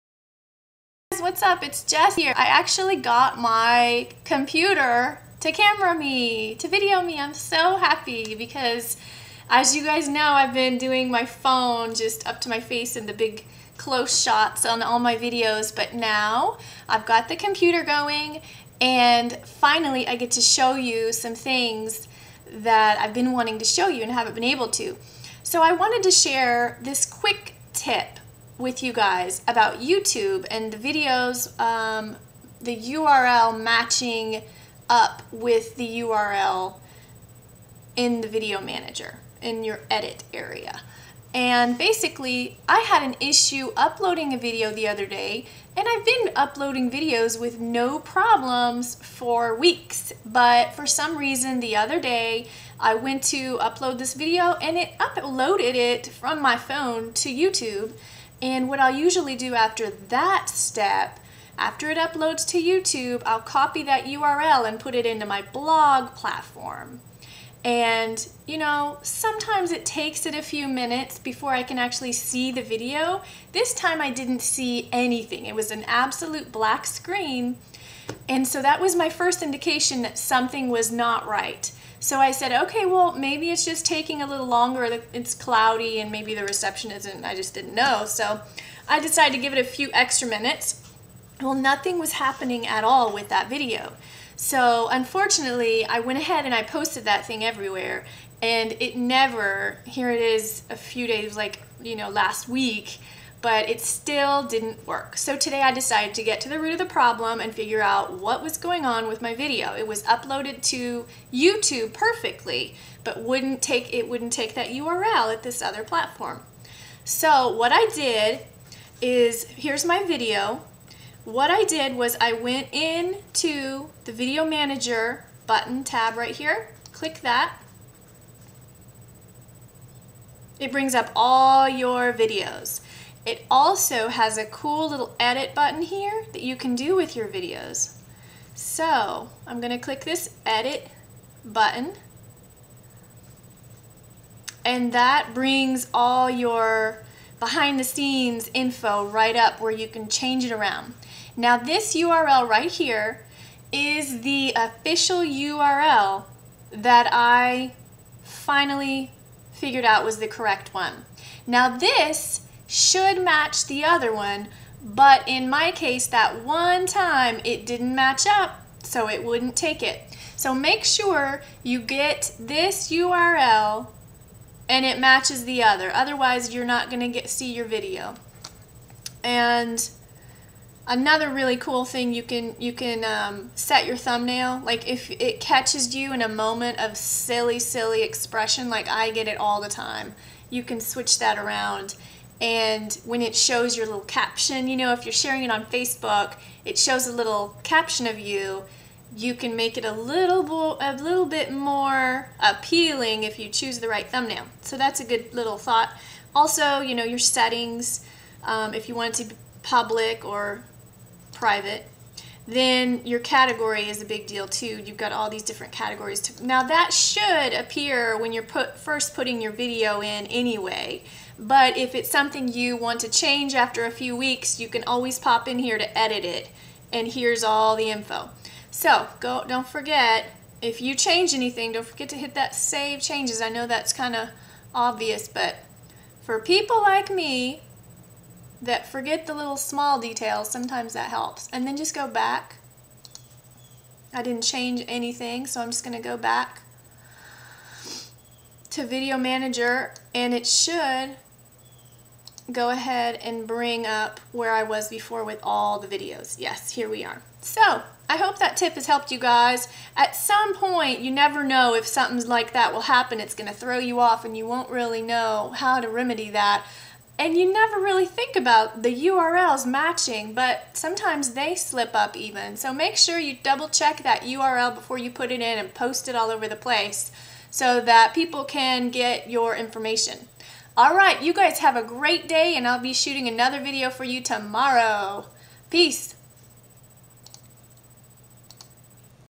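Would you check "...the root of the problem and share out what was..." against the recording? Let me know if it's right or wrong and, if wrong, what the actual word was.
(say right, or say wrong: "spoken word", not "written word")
wrong: "figure", not "share".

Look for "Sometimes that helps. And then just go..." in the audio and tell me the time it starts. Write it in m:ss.
4:00.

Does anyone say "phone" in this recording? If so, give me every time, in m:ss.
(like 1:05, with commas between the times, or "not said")
0:11, 0:56.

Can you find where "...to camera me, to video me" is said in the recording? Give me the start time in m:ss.
0:05.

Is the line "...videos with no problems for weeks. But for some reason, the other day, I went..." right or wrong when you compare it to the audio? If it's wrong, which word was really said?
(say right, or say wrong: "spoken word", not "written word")
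right.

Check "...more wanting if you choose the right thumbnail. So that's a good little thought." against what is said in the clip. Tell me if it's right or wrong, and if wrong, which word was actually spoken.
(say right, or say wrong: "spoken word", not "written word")
wrong: "appealing", not "wanting".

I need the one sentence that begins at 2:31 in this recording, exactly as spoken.
Now this URL right here is the official URL that I finally figured out was the correct one.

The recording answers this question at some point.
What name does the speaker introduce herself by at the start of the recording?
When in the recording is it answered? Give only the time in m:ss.
0:01.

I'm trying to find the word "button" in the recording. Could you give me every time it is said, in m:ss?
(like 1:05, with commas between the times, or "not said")
2:05, 2:15, 2:21.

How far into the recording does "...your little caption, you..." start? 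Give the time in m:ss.
3:13.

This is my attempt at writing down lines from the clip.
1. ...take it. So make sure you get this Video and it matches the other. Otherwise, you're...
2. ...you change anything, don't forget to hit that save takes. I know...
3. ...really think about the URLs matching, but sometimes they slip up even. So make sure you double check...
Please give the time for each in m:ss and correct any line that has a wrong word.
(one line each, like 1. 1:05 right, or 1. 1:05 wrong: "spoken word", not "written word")
1. 2:49 wrong: "URL", not "Video"
2. 3:50 wrong: "changes", not "takes"
3. 4:27 right.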